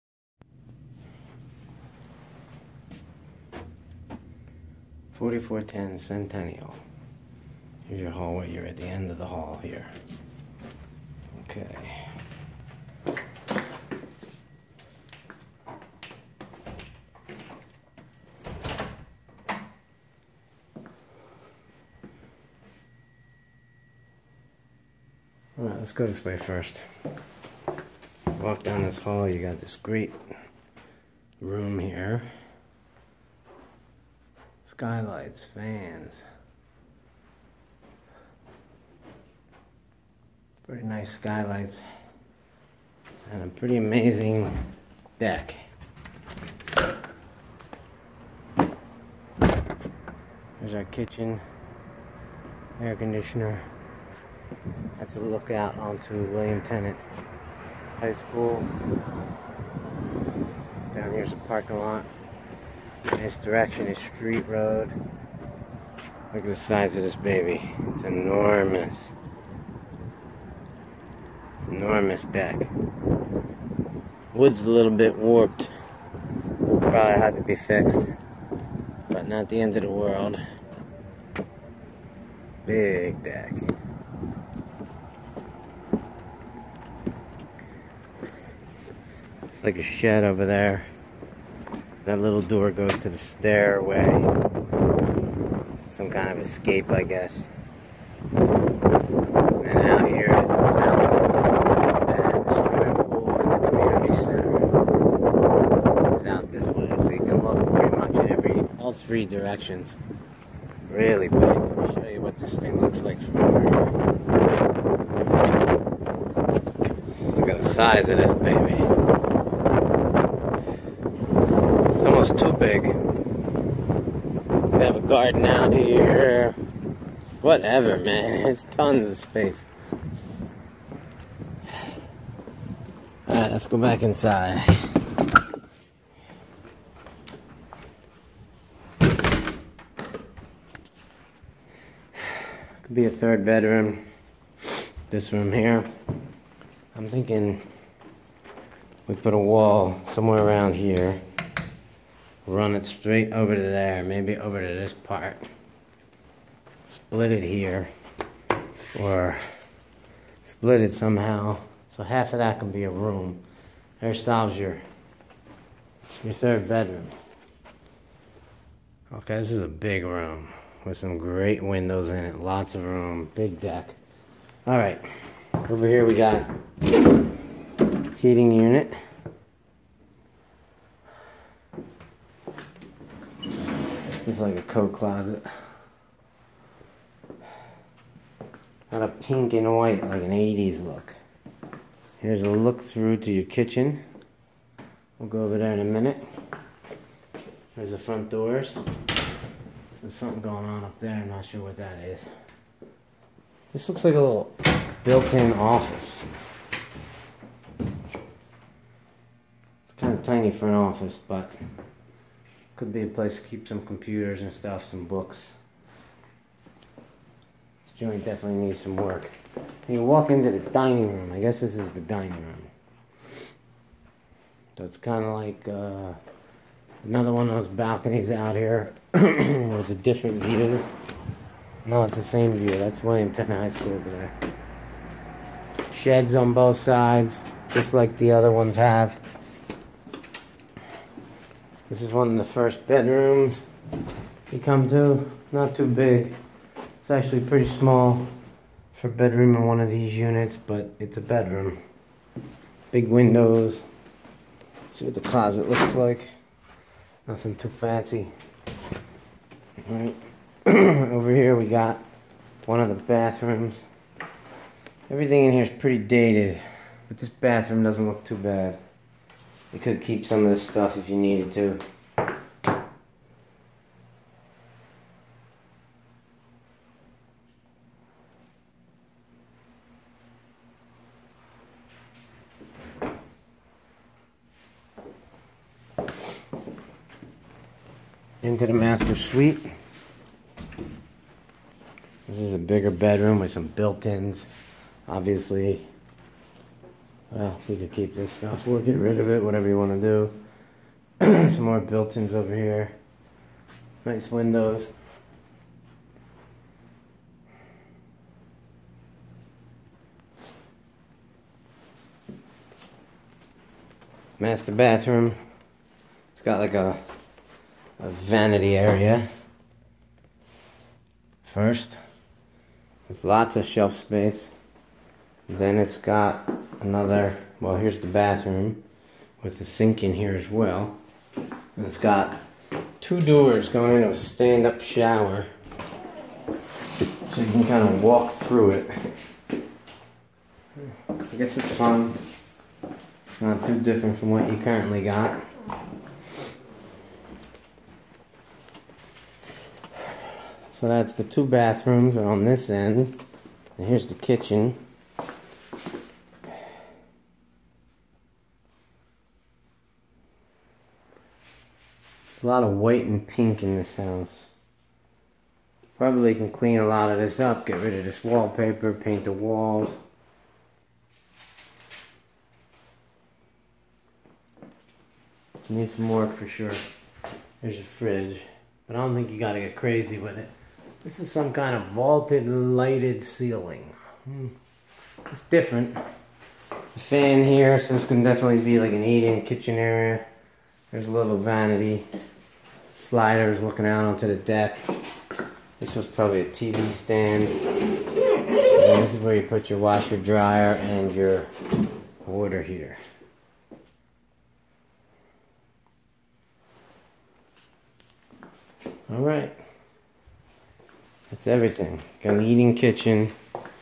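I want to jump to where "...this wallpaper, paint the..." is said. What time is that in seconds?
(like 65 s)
368 s.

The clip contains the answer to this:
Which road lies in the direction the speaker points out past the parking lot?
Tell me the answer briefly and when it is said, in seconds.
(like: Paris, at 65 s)
Street Road, at 64 s.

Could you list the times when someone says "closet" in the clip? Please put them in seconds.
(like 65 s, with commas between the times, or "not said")
184 s, 255 s.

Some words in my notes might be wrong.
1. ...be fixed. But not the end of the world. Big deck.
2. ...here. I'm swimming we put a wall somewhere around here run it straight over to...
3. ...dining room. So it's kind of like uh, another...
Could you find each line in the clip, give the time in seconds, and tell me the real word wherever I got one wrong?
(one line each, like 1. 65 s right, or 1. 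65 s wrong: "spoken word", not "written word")
1. 77 s right
2. 145 s wrong: "thinking", not "swimming"
3. 222 s right.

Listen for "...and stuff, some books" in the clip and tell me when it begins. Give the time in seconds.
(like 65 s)
214 s.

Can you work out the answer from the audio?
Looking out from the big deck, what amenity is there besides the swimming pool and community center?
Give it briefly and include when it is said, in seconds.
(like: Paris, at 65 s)
fountain, at 100 s.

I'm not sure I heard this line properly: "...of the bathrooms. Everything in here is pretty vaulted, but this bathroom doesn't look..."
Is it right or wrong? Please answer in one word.
wrong.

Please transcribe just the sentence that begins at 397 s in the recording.
And this is where you put your washer, dryer, and your water heater.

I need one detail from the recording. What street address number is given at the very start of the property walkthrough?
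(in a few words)
4410.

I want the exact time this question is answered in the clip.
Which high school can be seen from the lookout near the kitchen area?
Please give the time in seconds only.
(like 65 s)
56 s.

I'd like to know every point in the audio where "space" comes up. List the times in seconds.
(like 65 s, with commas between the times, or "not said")
129 s, 323 s.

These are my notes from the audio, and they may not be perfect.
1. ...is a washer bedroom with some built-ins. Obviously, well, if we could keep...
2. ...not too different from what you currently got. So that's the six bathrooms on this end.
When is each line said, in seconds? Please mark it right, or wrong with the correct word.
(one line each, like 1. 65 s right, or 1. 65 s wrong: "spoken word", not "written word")
1. 292 s wrong: "bigger", not "washer"
2. 343 s wrong: "two", not "six".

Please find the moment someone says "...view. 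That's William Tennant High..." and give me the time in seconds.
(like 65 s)
232 s.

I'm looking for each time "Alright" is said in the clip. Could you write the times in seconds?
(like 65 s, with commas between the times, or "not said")
25 s, 133 s.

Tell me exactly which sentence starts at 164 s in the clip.
There solves your, your third bedroom.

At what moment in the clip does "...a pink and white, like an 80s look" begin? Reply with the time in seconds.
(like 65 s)
189 s.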